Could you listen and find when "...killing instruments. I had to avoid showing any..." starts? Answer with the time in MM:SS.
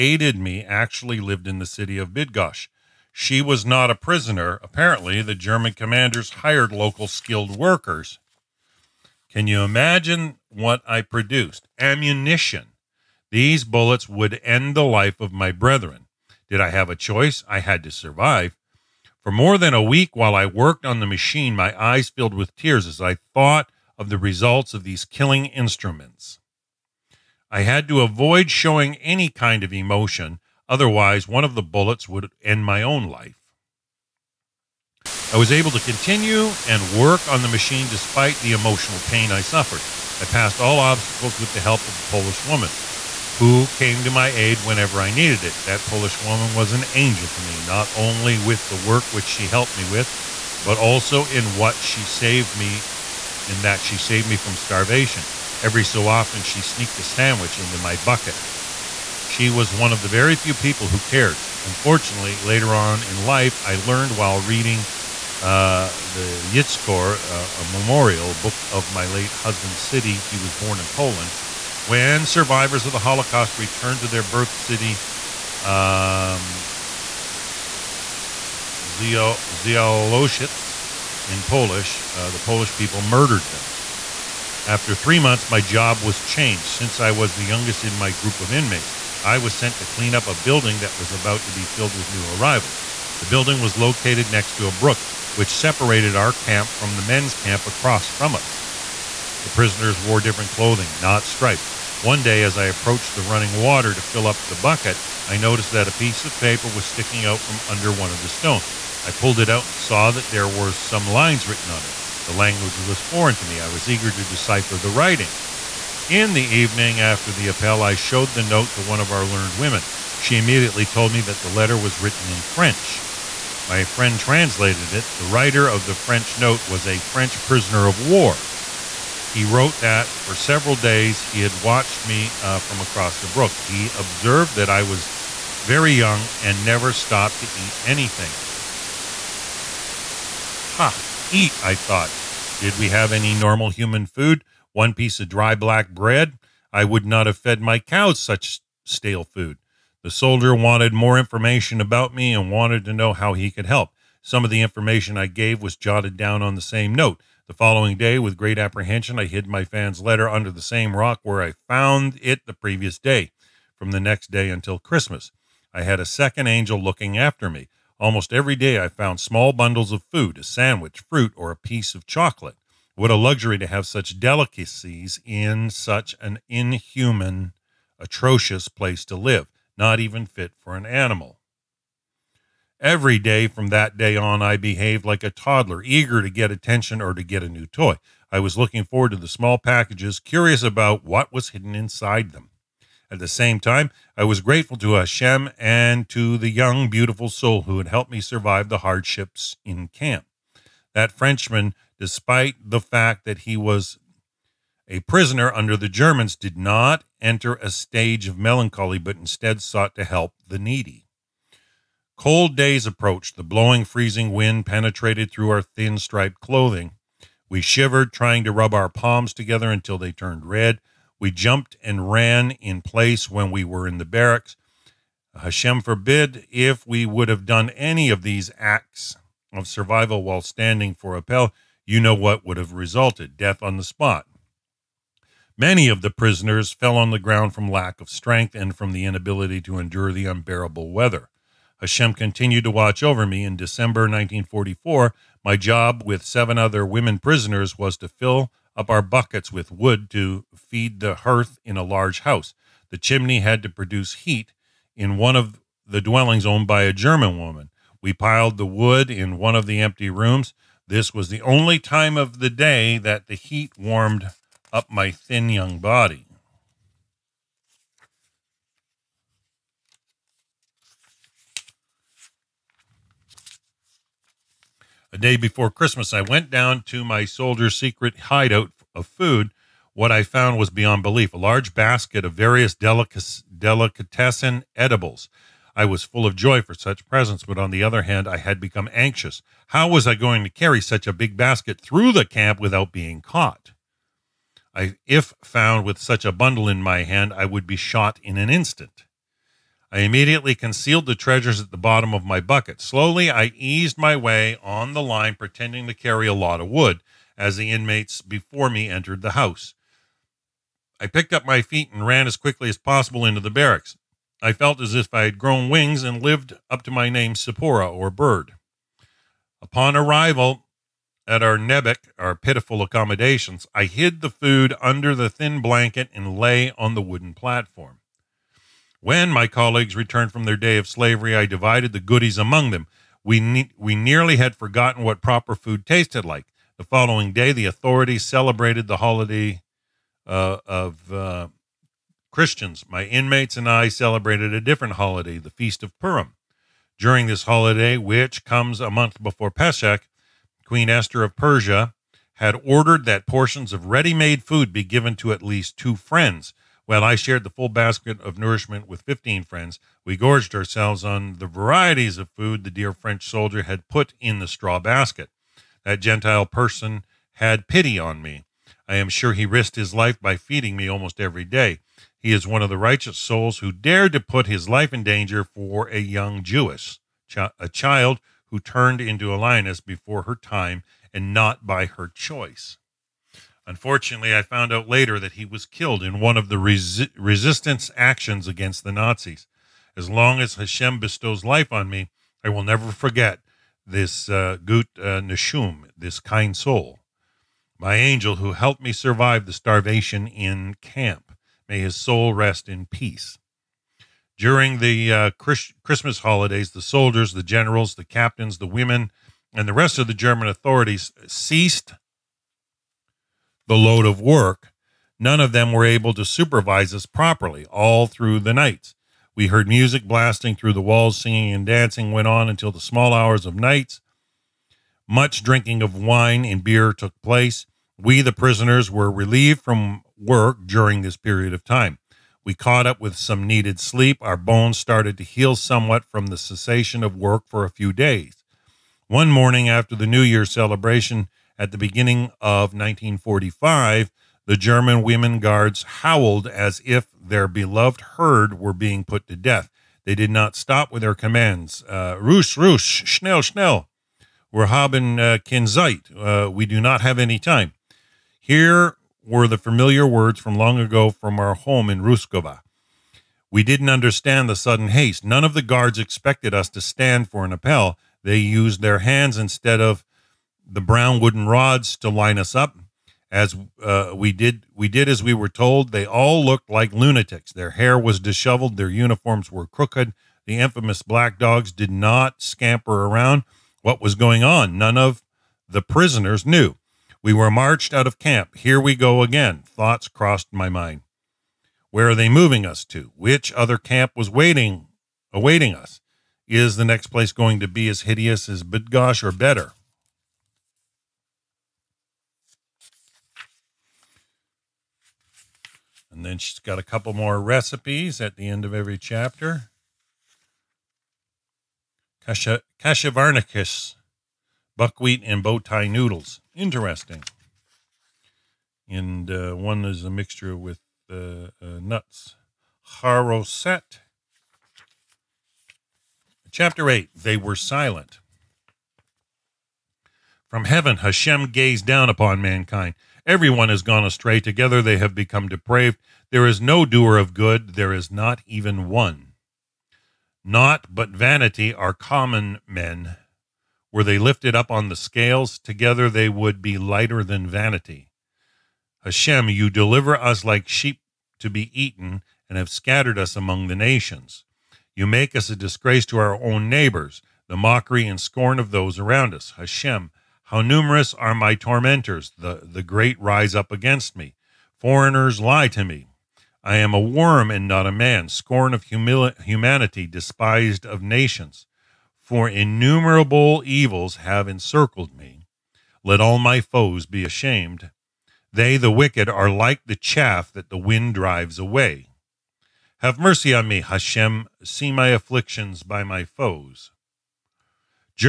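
00:25.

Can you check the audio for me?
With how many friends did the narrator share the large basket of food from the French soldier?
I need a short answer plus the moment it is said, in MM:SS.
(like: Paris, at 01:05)
15, at 05:59.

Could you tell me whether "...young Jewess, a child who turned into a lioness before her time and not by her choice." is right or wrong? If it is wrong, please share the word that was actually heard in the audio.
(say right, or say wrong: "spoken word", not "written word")
right.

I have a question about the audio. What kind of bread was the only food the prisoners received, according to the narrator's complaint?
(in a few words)
Dry black bread.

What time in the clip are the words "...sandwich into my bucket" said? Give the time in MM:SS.
00:57.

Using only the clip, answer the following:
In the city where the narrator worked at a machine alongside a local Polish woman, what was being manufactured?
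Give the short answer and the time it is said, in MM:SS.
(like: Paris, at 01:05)
Ammunition, at 00:11.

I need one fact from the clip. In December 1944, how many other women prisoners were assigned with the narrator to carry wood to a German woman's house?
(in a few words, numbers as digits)
Seven.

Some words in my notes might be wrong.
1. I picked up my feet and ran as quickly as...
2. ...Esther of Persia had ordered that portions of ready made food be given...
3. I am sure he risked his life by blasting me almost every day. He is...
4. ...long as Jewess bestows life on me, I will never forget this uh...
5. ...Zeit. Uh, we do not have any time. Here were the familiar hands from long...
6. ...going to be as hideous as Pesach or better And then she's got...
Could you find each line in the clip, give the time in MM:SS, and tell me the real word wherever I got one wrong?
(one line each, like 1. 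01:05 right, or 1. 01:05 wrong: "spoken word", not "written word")
1. 05:10 right
2. 05:50 right
3. 06:08 wrong: "feeding", not "blasting"
4. 06:30 wrong: "Hashem", not "Jewess"
5. 07:35 wrong: "words", not "hands"
6. 08:17 wrong: "Bydgoszcz", not "Pesach".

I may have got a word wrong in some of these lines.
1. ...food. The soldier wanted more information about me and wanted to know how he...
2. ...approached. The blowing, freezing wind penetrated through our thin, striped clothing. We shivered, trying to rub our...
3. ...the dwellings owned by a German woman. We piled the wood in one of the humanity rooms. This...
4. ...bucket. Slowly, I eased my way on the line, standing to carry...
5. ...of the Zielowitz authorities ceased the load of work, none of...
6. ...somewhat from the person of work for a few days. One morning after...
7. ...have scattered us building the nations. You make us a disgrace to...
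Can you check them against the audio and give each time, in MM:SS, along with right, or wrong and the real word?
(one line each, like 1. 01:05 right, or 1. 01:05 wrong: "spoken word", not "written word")
1. 02:29 right
2. 03:32 right
3. 04:15 wrong: "empty", not "humanity"
4. 05:02 wrong: "pretending", not "standing"
5. 06:49 wrong: "German", not "Zielowitz"
6. 07:15 wrong: "cessation", not "person"
7. 09:12 wrong: "among", not "building".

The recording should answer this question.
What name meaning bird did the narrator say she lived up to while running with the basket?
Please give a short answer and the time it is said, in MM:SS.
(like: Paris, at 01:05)
Sipora, at 05:17.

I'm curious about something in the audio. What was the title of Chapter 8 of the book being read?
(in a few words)
They Were Silent.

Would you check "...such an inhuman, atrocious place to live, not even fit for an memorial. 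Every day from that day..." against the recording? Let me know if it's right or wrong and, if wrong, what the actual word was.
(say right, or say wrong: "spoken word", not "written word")
wrong: "animal", not "memorial".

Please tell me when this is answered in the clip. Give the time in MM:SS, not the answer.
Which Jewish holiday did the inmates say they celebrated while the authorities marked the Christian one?
05:45.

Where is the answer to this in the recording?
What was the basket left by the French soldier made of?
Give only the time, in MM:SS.
06:04.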